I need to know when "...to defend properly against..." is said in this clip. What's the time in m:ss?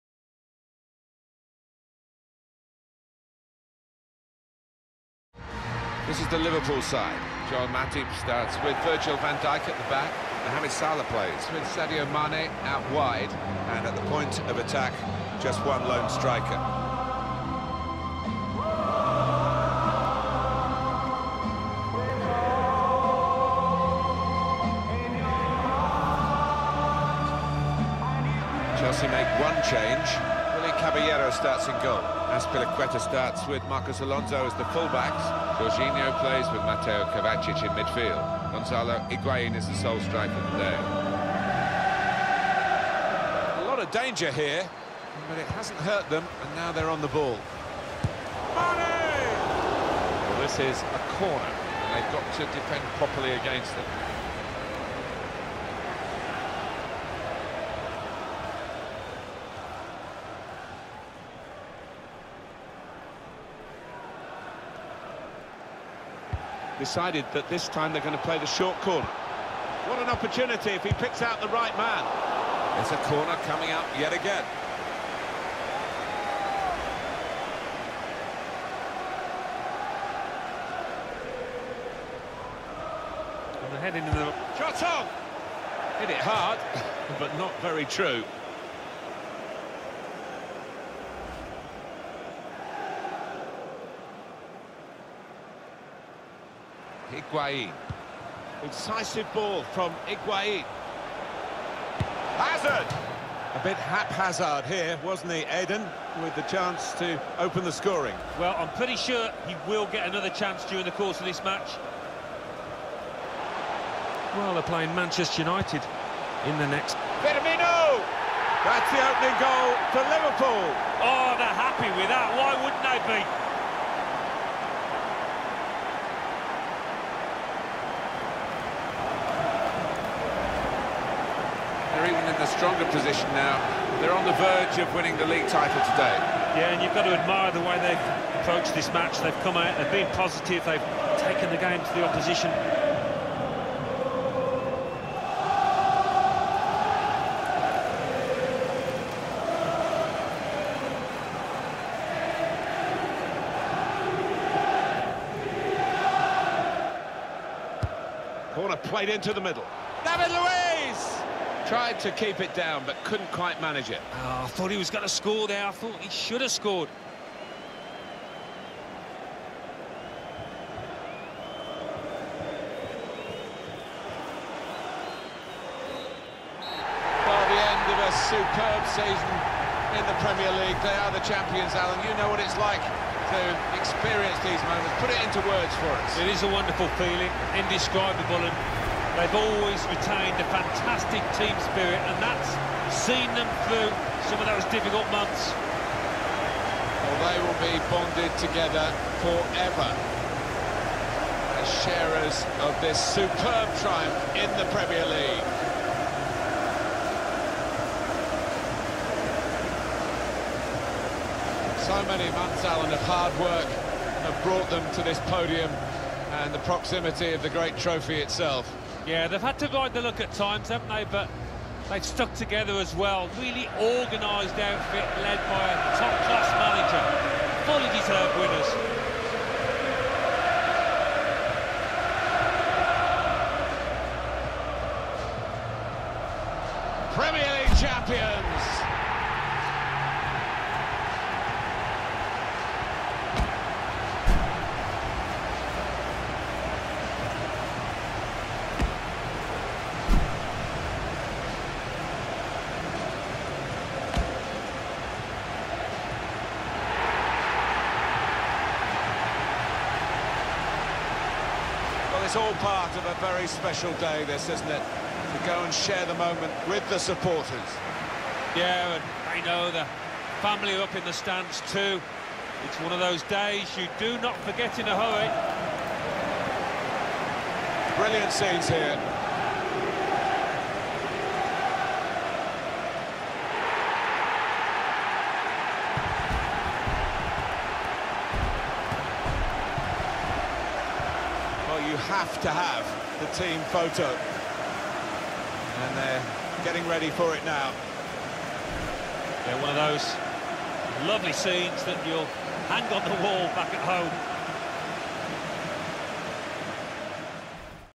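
0:52.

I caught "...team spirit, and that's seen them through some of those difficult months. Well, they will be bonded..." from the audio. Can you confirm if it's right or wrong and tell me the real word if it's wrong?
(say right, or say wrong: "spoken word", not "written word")
right.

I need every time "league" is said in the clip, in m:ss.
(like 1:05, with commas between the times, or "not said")
2:15, 3:00, 3:25, 3:57.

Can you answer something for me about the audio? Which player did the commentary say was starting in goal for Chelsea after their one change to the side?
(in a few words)
Caballero.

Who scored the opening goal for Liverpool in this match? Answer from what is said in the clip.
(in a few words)
Firmino.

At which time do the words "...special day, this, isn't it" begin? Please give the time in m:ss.
4:23.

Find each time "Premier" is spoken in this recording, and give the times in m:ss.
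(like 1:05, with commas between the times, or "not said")
3:00, 3:24, 3:57.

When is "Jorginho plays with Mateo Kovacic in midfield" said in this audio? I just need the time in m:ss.
0:35.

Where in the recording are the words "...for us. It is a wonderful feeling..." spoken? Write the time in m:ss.
3:05.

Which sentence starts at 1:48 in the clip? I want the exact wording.
Well, I'm pretty sure he will get another chance during the course of this match.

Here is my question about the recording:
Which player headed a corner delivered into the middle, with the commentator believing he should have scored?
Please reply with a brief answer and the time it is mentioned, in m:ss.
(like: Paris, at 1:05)
David Luiz, at 2:40.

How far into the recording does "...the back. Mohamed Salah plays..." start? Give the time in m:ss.
0:09.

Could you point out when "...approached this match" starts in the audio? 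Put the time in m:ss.
2:18.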